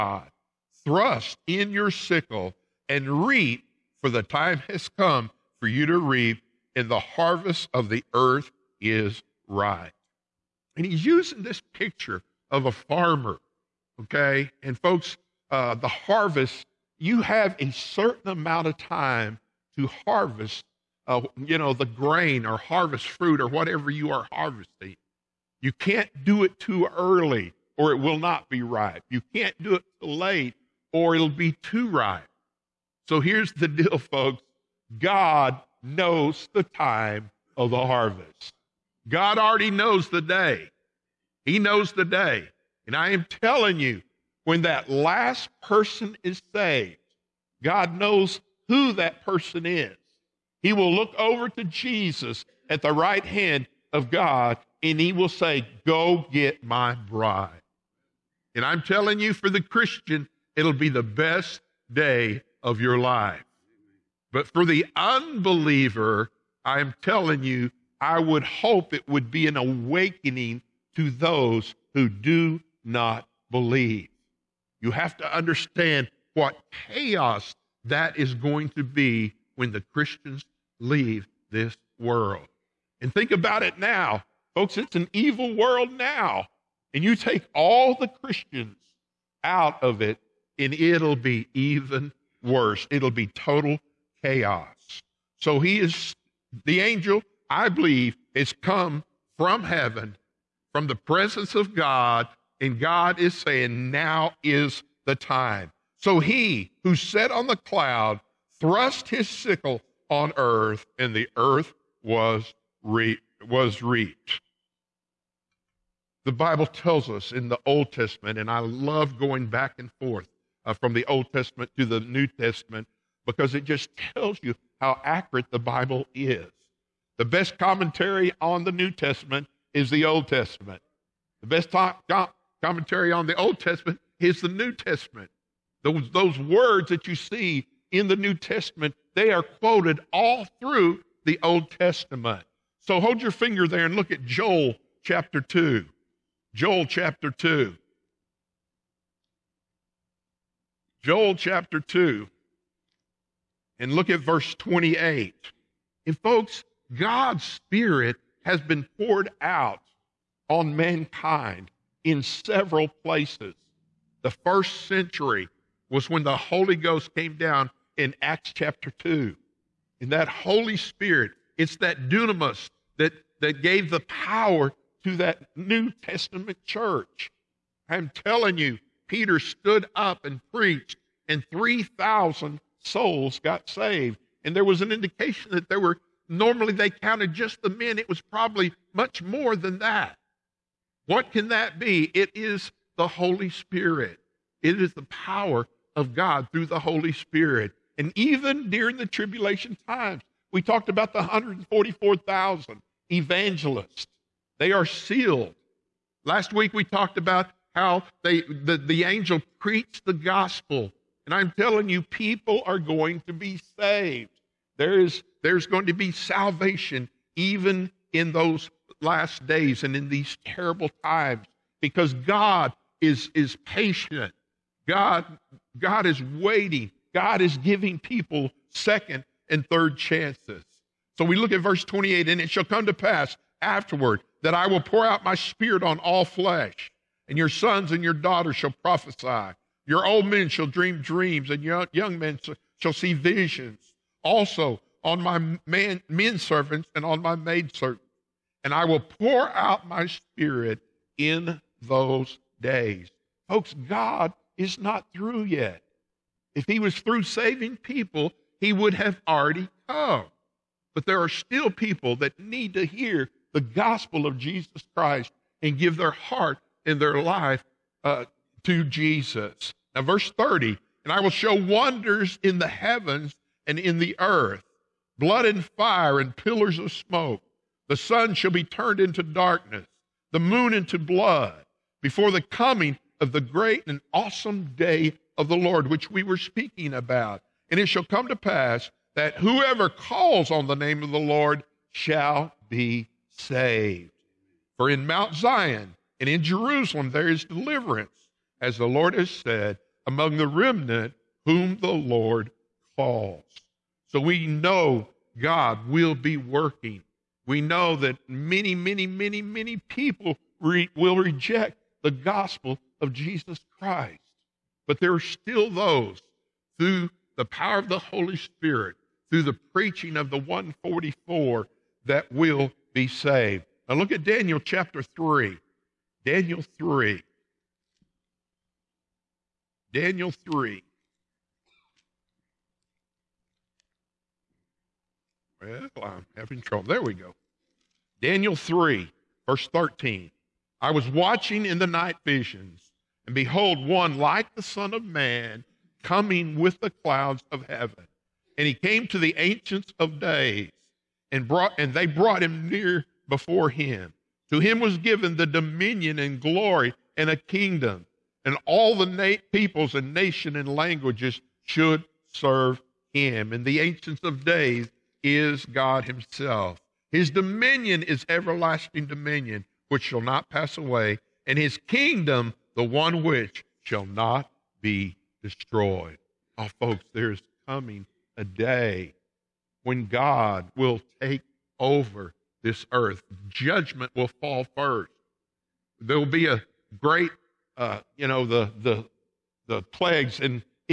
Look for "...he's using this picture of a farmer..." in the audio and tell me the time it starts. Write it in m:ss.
0:10.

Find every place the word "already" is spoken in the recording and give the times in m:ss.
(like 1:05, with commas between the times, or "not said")
0:39, 4:19.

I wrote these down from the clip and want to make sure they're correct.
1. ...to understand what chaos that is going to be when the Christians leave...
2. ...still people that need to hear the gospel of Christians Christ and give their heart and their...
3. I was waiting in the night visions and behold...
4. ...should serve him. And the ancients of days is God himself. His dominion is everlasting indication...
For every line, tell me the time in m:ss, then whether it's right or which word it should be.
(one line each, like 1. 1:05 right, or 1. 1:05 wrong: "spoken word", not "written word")
1. 1:15 right
2. 4:21 wrong: "Jesus", not "Christians"
3. 5:40 wrong: "watching", not "waiting"
4. 6:01 wrong: "dominion", not "indication".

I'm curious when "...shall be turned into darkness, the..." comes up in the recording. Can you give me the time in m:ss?
4:38.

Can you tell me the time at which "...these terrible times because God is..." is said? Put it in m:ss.
3:40.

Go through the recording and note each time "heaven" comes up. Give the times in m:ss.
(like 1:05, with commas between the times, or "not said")
1:39, 4:32, 5:47.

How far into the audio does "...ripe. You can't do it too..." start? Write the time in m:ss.
0:28.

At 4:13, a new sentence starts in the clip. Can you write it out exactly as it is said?
Folks, God is not through yet.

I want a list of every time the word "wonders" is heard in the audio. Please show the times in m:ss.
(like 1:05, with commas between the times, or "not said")
4:31.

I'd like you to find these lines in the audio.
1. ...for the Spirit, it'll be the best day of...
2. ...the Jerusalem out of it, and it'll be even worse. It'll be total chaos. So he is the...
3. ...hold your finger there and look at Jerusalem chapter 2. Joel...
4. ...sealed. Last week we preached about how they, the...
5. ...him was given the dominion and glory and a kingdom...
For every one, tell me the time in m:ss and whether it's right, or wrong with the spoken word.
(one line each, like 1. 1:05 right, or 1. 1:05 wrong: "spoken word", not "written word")
1. 0:59 wrong: "Christian", not "Spirit"
2. 1:27 wrong: "Christians", not "Jerusalem"
3. 2:22 wrong: "Joel", not "Jerusalem"
4. 3:24 wrong: "talked", not "preached"
5. 5:54 right.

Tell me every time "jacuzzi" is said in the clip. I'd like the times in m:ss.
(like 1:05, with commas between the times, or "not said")
not said.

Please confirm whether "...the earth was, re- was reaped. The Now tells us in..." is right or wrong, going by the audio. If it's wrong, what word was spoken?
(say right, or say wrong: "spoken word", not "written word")
wrong: "Bible", not "Now".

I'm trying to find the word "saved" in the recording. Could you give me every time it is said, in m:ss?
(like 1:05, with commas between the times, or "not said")
0:46, 3:03, 3:33, 4:53, 5:23.